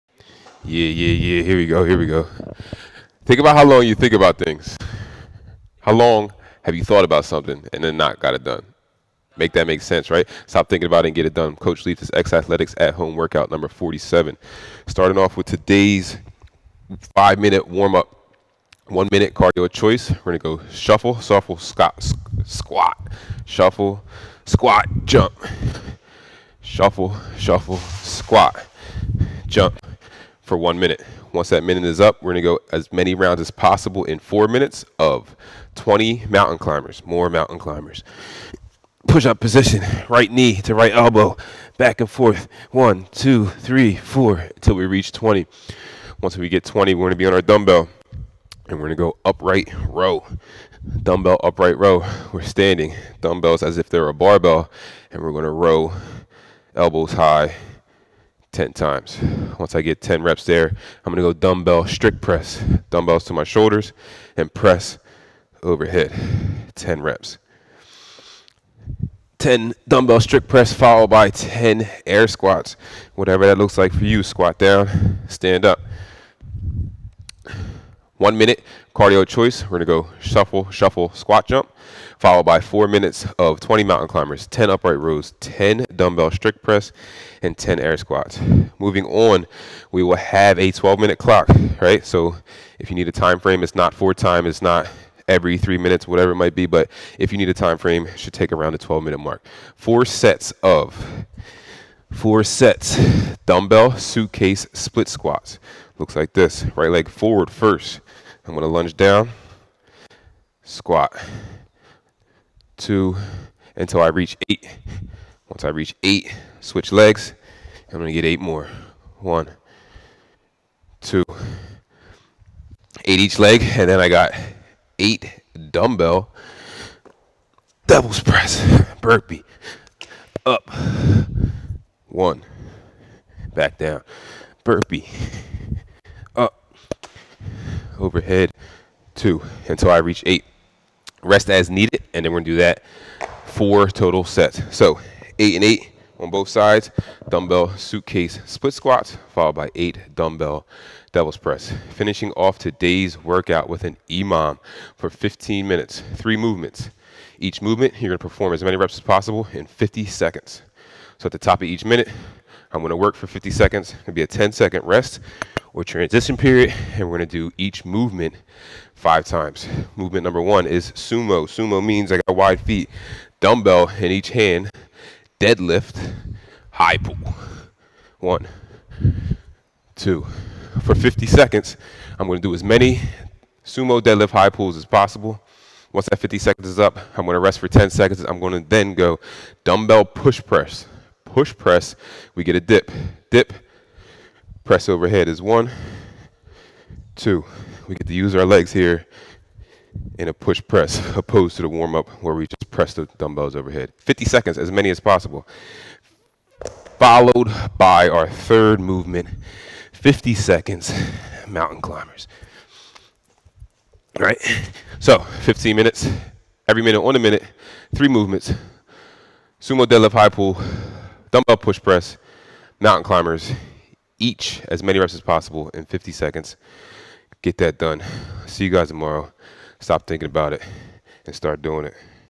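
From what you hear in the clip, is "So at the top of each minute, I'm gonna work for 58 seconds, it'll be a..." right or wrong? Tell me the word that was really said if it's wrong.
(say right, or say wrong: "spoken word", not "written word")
wrong: "50", not "58".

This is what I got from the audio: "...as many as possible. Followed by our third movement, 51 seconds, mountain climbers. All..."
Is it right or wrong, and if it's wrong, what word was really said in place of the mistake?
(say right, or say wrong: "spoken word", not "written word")
wrong: "50", not "51".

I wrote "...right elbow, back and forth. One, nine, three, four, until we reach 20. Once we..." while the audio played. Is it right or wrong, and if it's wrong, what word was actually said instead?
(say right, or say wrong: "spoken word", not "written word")
wrong: "two", not "nine".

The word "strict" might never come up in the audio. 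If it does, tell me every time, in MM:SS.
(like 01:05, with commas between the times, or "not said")
01:01, 01:10, 01:26.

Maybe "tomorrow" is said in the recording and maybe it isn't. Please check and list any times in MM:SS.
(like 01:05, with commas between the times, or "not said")
03:48.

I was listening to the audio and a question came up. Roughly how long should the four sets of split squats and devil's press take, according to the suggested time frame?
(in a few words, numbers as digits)
12 minutes.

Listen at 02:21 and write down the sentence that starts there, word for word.
Rest as needed, and then we're gonna do that four total sets.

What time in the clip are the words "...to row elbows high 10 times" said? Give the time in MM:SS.
00:55.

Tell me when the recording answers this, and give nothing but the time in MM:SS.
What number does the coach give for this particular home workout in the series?
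00:13.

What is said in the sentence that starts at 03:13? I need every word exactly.
Dip, press overhead is one, two.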